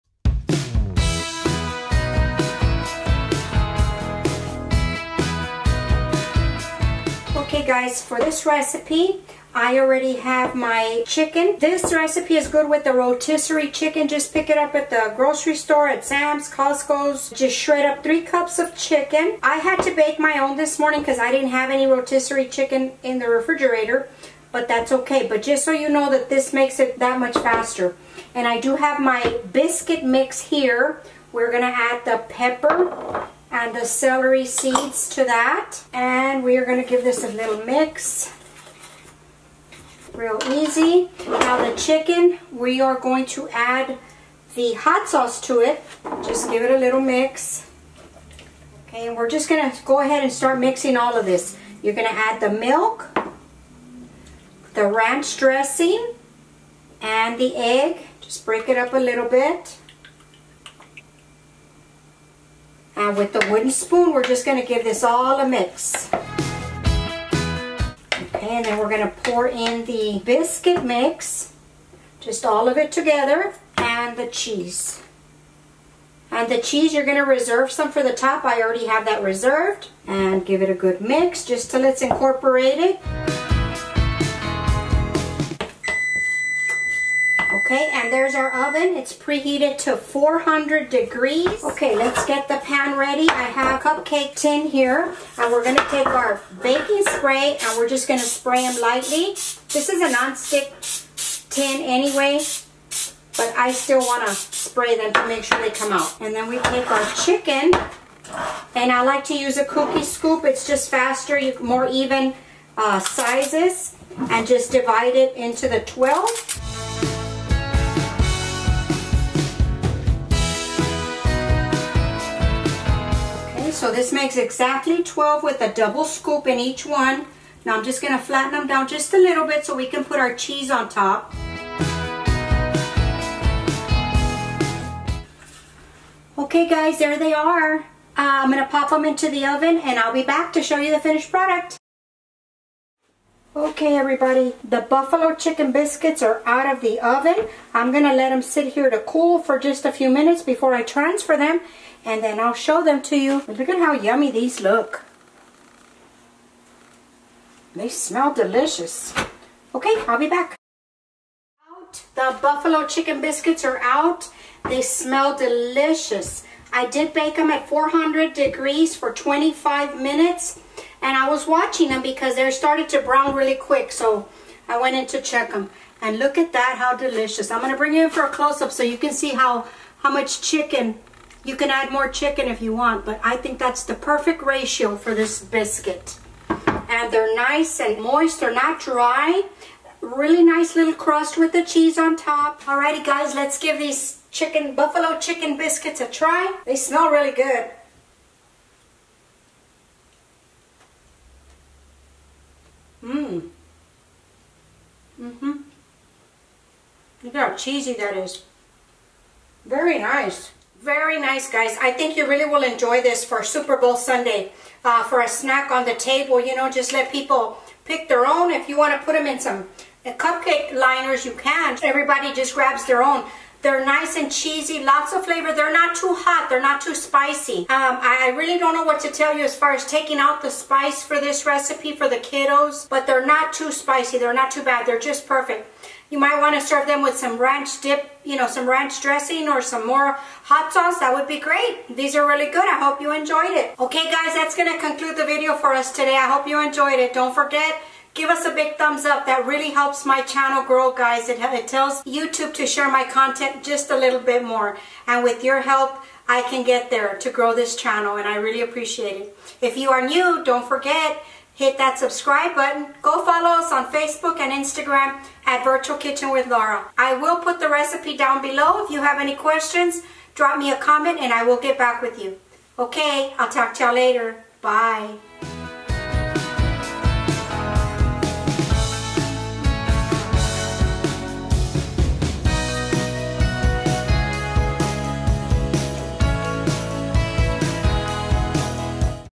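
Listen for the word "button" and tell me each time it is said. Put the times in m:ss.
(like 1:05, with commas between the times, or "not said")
4:22.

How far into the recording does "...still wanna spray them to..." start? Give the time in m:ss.
1:43.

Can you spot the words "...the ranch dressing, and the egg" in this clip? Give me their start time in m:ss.
0:54.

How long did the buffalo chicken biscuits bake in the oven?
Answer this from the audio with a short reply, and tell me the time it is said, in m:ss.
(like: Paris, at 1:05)
25 minutes, at 2:49.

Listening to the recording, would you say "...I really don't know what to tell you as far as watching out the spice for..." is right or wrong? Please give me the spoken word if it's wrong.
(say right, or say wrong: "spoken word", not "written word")
wrong: "taking", not "watching".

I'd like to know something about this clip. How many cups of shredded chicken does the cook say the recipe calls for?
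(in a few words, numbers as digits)
3 cups.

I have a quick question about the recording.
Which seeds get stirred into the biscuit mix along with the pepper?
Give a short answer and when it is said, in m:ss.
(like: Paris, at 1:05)
celery seeds, at 0:33.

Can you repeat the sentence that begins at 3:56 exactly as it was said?
You might want to serve them with some ranch dip, you know, some ranch dressing or some more hot sauce.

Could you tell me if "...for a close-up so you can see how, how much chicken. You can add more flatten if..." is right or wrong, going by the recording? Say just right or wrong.
wrong.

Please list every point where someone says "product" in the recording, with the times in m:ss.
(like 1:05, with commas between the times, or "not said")
2:21.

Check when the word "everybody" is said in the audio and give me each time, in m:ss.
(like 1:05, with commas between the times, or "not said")
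2:23, 3:41.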